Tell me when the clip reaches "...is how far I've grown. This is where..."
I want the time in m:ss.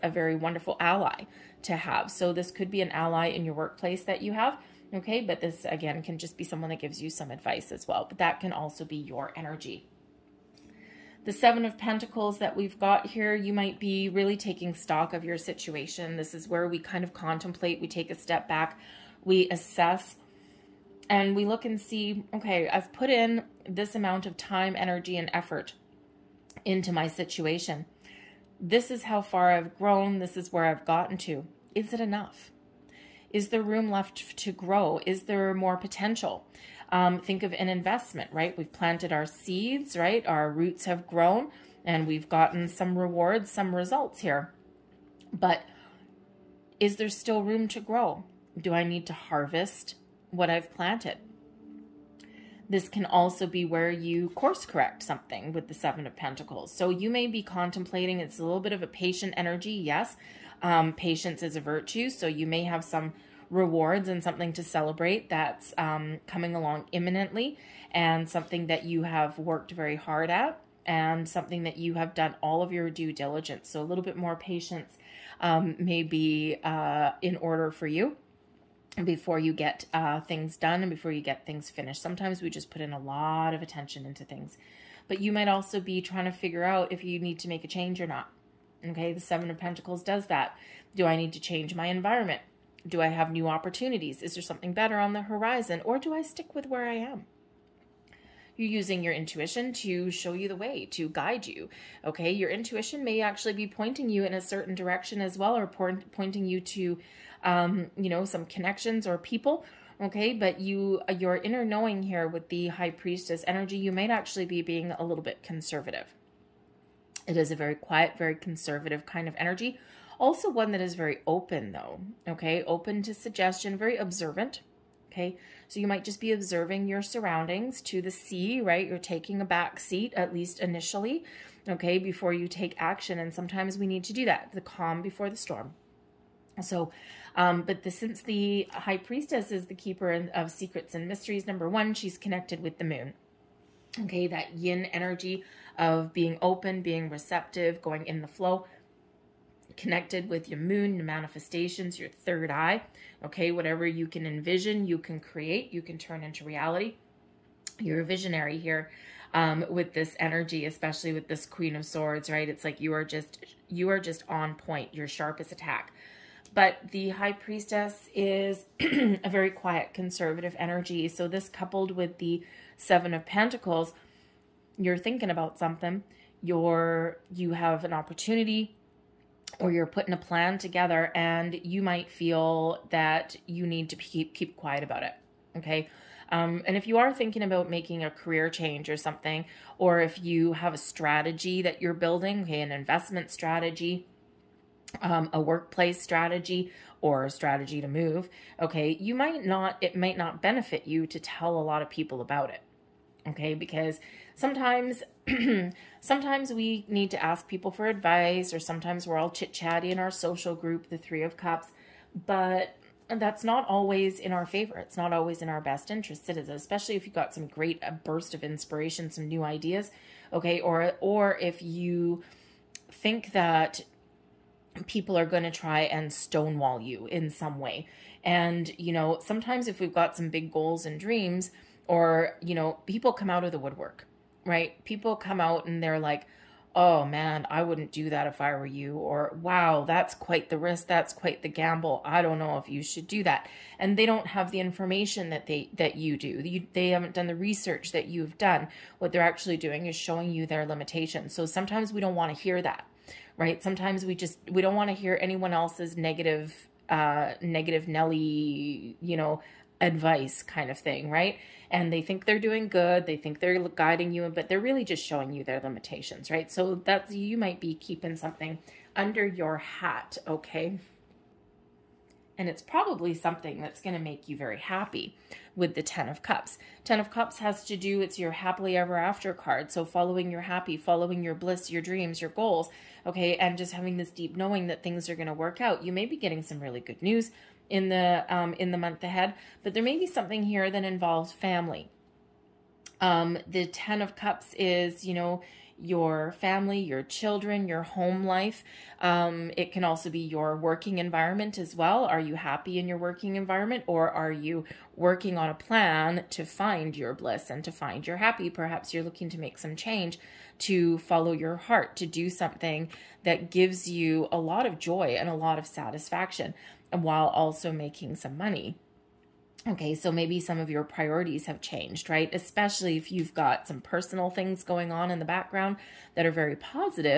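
0:28.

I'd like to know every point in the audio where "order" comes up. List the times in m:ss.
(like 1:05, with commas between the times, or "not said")
1:17.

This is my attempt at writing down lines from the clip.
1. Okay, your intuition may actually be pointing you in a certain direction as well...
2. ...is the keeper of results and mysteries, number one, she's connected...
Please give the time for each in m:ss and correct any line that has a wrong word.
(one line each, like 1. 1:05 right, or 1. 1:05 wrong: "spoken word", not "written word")
1. 1:42 right
2. 2:19 wrong: "secrets", not "results".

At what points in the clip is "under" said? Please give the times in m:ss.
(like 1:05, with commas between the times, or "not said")
4:28.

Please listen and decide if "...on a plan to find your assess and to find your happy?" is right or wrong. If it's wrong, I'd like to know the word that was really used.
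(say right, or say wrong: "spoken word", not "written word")
wrong: "bliss", not "assess".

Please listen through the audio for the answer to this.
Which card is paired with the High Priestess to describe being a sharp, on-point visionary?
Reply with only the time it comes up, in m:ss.
2:41.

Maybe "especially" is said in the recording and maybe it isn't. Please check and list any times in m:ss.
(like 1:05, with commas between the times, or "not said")
2:40, 3:36, 5:22.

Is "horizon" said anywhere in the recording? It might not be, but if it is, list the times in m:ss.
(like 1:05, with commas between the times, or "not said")
1:35.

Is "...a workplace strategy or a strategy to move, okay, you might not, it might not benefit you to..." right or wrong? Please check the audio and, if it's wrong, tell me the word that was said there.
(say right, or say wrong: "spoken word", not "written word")
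right.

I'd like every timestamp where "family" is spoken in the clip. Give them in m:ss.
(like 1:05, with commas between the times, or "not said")
4:51, 4:56.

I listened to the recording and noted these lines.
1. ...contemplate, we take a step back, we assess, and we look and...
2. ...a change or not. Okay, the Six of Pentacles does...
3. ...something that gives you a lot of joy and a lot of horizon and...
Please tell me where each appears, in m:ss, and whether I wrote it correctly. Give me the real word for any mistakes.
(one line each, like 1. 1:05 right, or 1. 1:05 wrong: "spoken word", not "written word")
1. 0:17 right
2. 1:27 wrong: "Seven", not "Six"
3. 5:12 wrong: "satisfaction", not "horizon".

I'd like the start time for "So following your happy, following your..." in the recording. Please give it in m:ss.
4:39.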